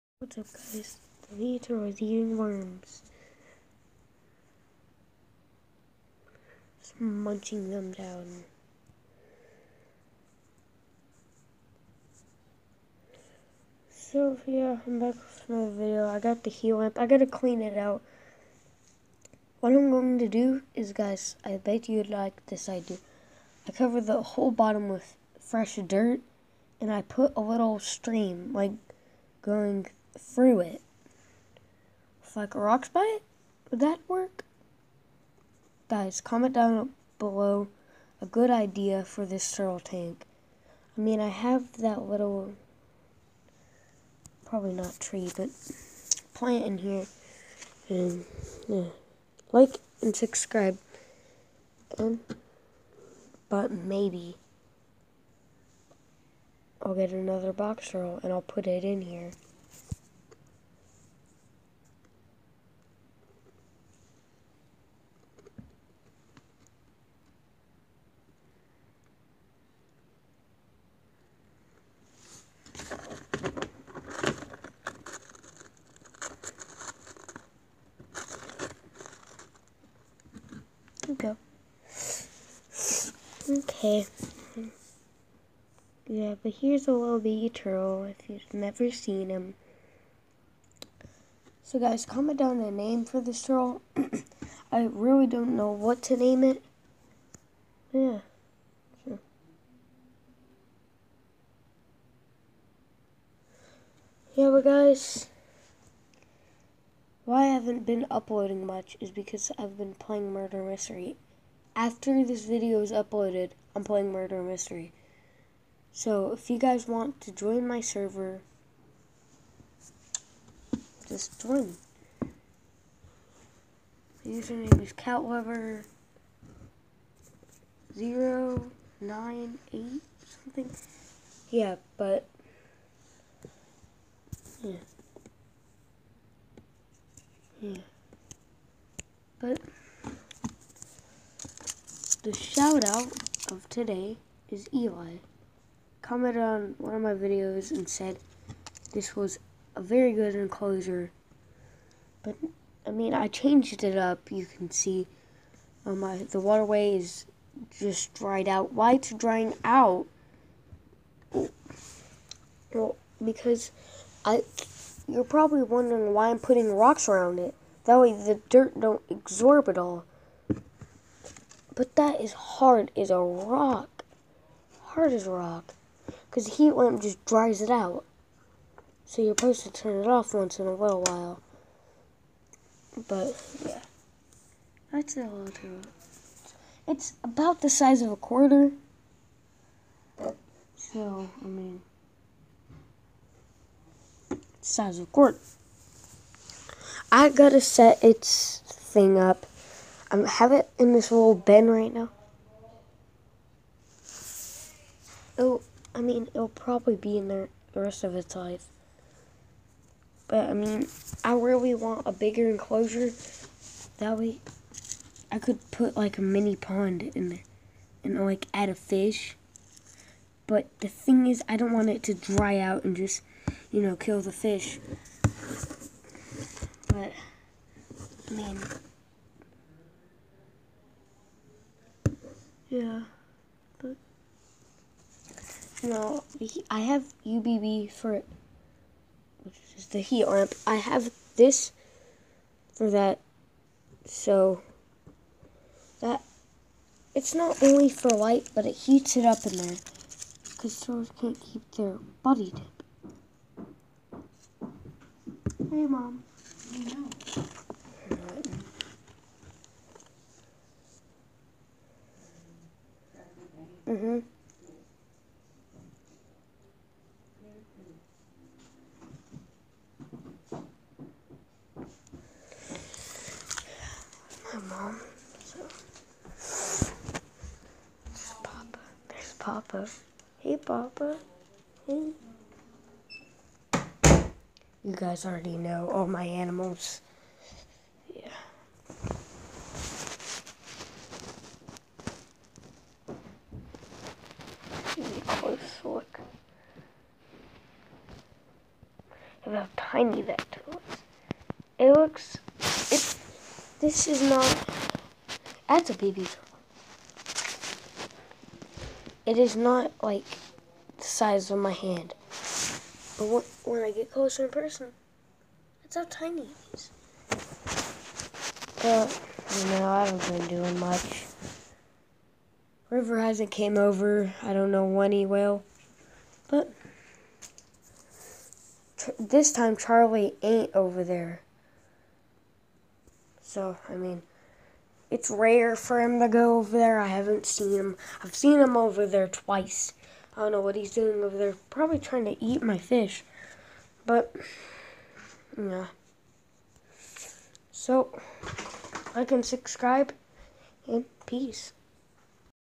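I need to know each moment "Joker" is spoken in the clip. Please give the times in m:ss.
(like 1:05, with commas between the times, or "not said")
not said.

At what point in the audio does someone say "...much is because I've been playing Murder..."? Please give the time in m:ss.
1:48.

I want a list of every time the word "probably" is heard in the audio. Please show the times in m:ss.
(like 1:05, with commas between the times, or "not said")
0:44, 2:45, 3:26, 5:41.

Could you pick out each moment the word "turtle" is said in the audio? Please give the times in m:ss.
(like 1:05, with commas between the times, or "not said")
0:39, 1:27, 1:33, 5:06.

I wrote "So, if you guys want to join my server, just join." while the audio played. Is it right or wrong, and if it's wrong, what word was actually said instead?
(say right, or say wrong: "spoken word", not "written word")
right.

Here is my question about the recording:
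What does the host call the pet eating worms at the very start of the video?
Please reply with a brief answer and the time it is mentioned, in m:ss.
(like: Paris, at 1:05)
The Leader, at 0:01.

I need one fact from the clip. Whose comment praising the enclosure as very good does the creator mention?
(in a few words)
Eli.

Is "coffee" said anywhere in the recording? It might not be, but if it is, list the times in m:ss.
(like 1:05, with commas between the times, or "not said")
not said.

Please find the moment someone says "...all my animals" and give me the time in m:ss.
4:45.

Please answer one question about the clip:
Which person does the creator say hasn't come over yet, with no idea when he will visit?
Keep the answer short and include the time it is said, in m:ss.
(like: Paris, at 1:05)
River, at 5:22.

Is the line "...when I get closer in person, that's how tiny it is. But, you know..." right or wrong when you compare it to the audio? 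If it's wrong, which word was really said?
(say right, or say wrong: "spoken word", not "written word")
right.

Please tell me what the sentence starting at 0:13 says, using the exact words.
So yeah, I'm back with another video.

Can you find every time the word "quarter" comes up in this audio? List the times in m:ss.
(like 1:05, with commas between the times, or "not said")
3:08, 3:15.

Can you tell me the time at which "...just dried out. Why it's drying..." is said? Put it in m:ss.
2:37.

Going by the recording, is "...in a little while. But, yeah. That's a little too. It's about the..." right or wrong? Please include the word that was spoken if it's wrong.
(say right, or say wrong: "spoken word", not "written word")
right.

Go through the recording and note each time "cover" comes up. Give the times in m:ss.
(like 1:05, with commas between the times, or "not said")
0:23.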